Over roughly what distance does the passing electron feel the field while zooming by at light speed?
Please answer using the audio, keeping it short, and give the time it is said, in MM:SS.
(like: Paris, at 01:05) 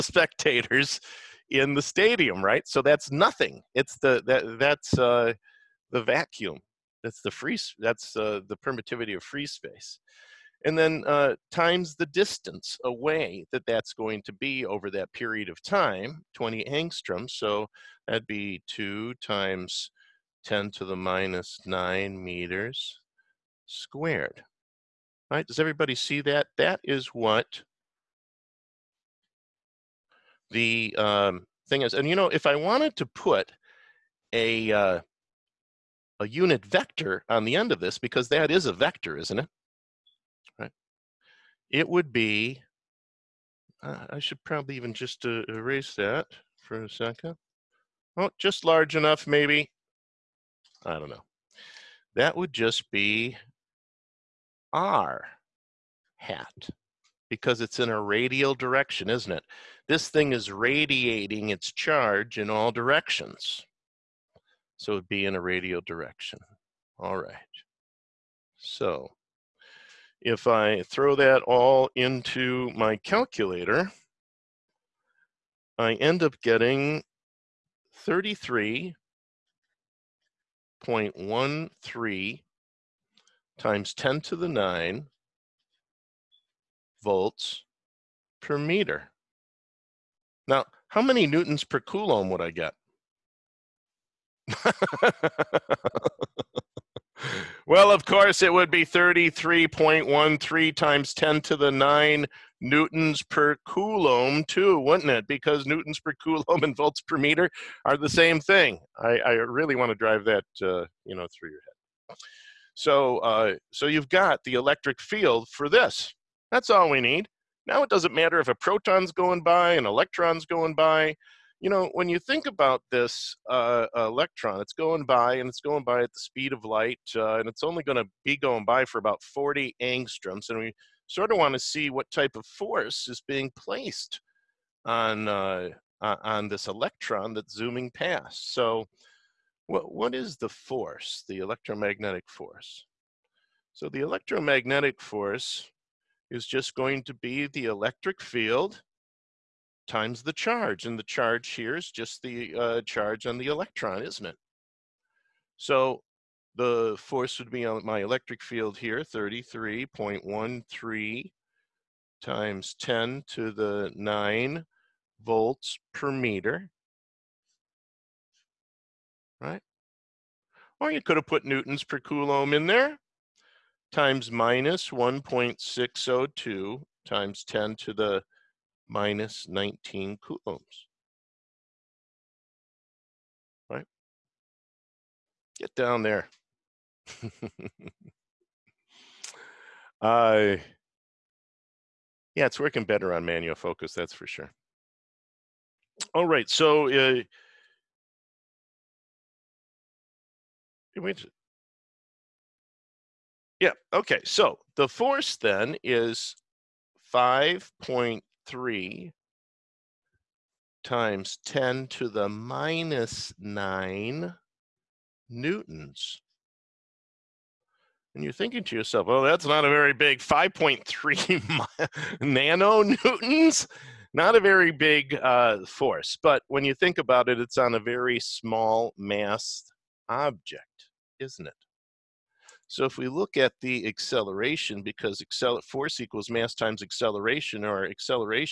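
40 angstroms, at 02:09.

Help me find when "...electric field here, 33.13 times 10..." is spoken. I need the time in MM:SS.
02:38.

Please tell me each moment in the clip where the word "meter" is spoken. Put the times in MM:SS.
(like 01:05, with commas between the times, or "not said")
00:22, 01:28, 01:47, 02:46.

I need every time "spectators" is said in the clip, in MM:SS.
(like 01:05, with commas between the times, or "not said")
00:00.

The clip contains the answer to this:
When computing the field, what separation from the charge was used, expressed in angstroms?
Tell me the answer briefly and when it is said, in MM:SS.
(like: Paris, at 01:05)
20 angstroms, at 00:16.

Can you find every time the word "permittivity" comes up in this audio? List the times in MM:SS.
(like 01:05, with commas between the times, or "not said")
00:08.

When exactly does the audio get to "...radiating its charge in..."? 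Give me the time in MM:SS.
01:00.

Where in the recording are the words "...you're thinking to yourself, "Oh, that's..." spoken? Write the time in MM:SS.
03:38.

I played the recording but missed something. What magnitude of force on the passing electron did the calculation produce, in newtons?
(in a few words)
5.3 times 10^-9 newtons.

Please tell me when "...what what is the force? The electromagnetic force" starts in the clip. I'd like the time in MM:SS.
02:19.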